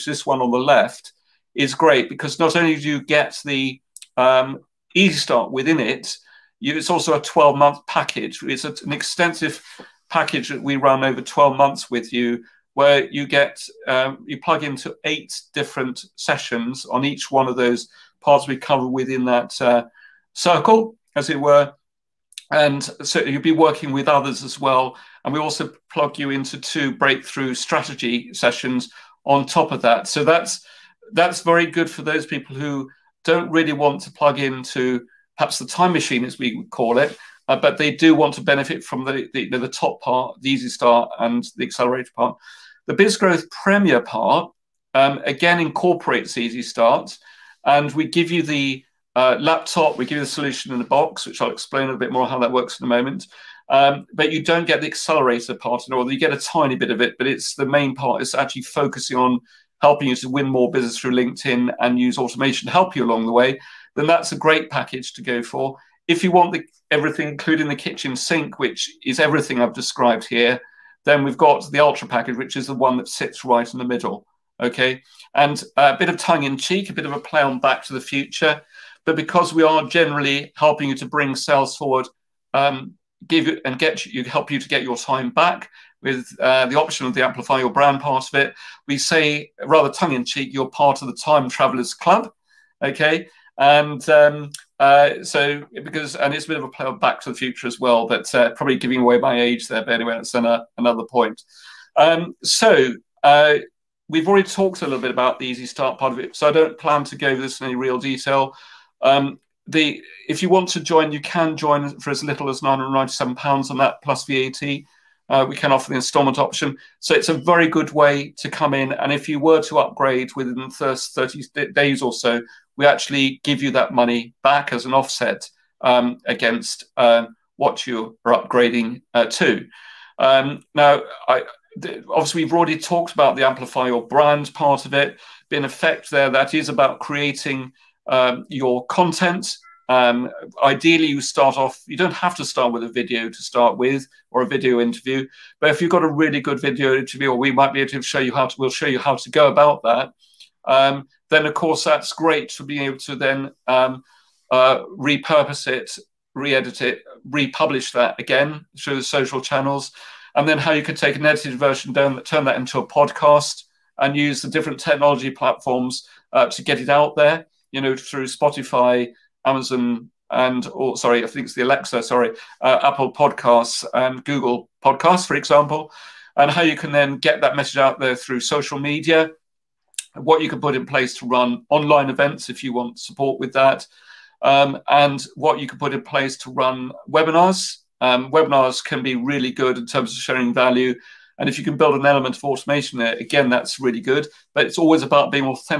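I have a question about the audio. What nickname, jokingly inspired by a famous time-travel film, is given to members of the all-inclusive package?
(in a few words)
Time Travelers Club.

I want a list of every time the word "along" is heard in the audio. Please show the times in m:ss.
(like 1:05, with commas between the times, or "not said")
1:03.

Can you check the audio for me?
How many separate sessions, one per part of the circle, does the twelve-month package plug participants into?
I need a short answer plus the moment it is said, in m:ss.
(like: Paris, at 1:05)
8, at 0:15.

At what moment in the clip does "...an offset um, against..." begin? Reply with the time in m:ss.
2:04.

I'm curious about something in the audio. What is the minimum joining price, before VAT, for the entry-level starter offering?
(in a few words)
£997.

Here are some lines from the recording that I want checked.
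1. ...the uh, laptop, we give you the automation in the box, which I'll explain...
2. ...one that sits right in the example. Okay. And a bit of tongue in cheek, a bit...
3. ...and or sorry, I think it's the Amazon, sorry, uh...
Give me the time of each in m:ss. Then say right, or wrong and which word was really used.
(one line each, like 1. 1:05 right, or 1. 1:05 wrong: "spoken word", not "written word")
1. 0:48 wrong: "solution", not "automation"
2. 1:12 wrong: "middle", not "example"
3. 2:50 wrong: "Alexa", not "Amazon".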